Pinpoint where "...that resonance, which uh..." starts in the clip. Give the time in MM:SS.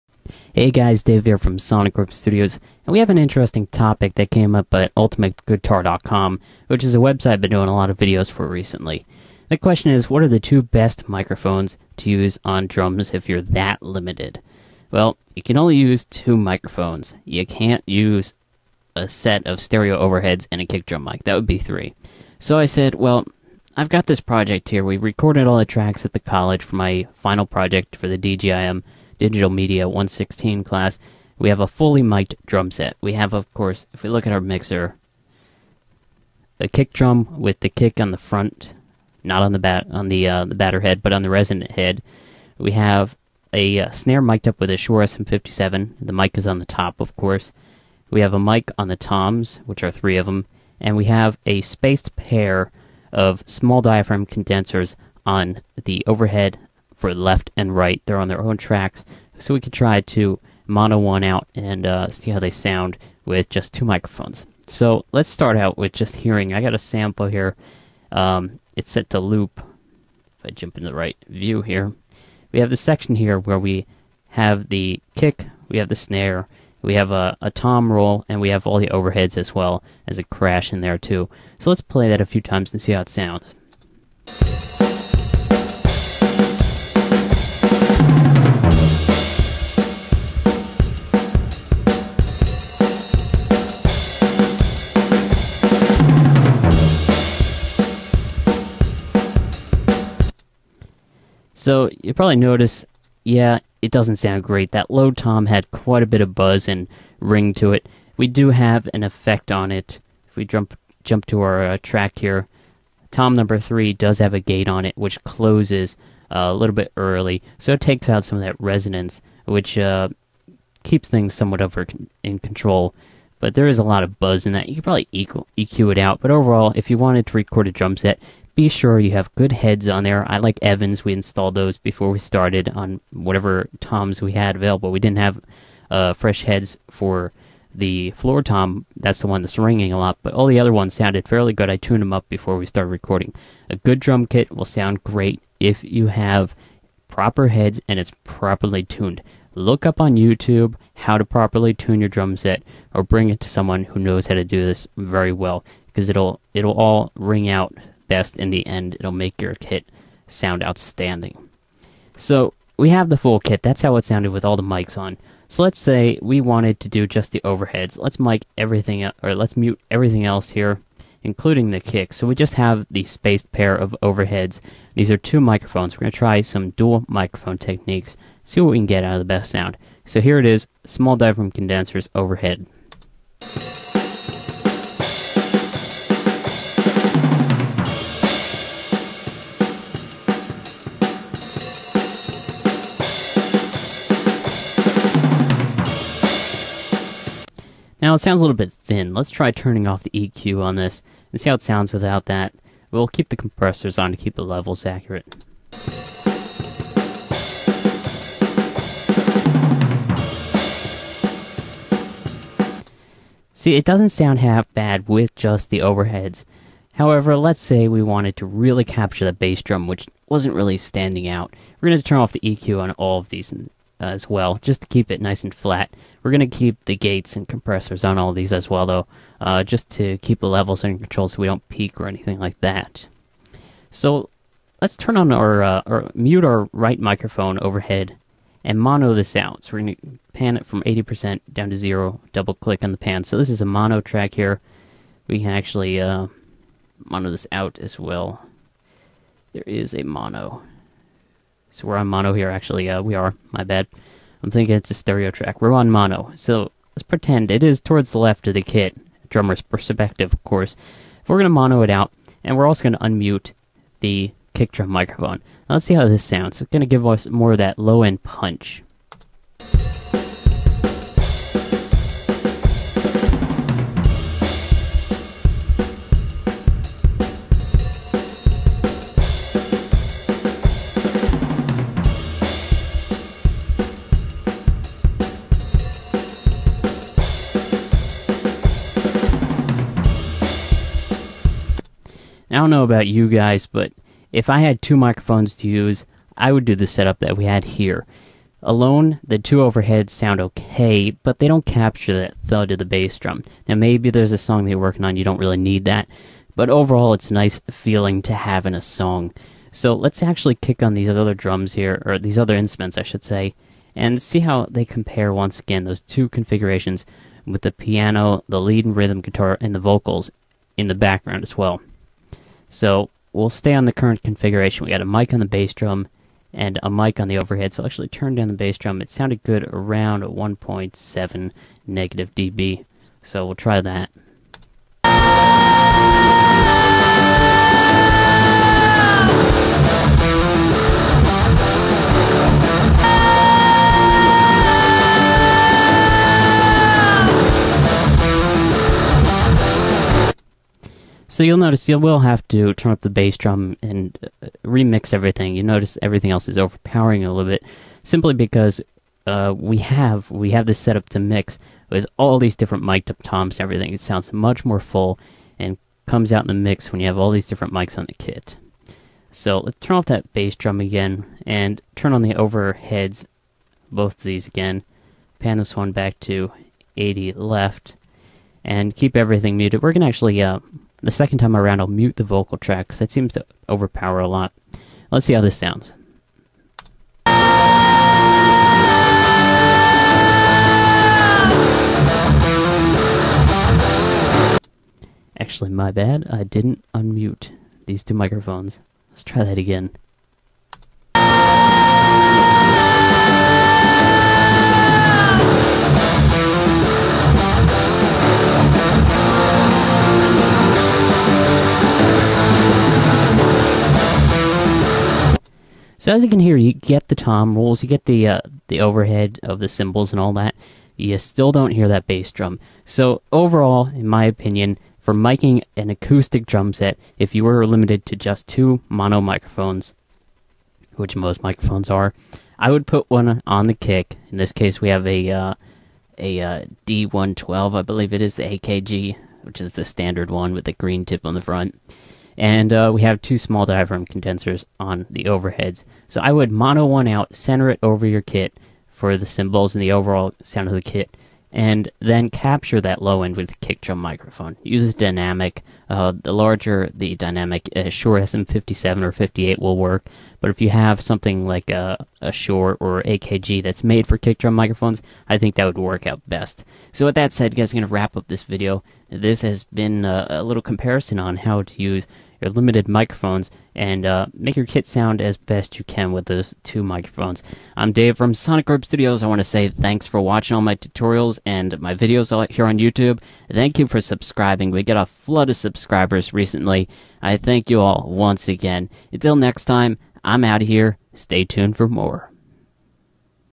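01:58.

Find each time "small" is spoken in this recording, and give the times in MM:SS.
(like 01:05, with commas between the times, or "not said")
00:53, 03:00, 07:23.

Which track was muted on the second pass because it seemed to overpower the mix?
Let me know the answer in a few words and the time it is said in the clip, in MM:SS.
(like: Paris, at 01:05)
vocal track, at 06:22.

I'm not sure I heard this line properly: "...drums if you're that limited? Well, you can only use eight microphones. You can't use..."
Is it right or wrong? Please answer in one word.
wrong.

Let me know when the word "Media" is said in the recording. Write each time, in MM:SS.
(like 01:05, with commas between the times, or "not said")
00:29.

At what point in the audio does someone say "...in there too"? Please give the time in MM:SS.
01:20.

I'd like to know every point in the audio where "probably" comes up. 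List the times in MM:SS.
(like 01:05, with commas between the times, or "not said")
01:42, 02:04.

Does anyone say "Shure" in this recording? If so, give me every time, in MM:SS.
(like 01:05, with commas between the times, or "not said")
00:44, 07:37, 07:42.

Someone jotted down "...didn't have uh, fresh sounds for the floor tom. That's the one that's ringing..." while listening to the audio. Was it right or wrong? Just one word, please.
wrong.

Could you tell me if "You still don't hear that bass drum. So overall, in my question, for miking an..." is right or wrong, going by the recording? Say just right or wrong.
wrong.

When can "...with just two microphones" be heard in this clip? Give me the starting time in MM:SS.
01:03.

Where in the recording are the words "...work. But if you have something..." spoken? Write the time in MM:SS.
07:39.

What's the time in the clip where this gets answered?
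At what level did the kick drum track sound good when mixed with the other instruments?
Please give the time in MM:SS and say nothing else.
05:30.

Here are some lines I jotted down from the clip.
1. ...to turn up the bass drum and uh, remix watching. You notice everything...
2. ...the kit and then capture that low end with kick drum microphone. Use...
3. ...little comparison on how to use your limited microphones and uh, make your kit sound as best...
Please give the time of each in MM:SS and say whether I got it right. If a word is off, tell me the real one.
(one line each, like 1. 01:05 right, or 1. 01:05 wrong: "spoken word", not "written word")
1. 05:52 wrong: "everything", not "watching"
2. 07:30 right
3. 07:50 right.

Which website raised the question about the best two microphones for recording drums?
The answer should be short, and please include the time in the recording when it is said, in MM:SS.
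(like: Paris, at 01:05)
ultimateguitar.com, at 00:04.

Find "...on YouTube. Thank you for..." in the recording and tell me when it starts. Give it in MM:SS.
08:02.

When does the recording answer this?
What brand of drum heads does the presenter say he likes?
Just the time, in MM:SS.
02:10.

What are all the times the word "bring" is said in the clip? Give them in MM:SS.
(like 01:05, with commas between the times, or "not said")
02:33.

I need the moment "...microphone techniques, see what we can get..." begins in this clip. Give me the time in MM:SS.
02:57.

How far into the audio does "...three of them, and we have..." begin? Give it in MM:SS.
00:49.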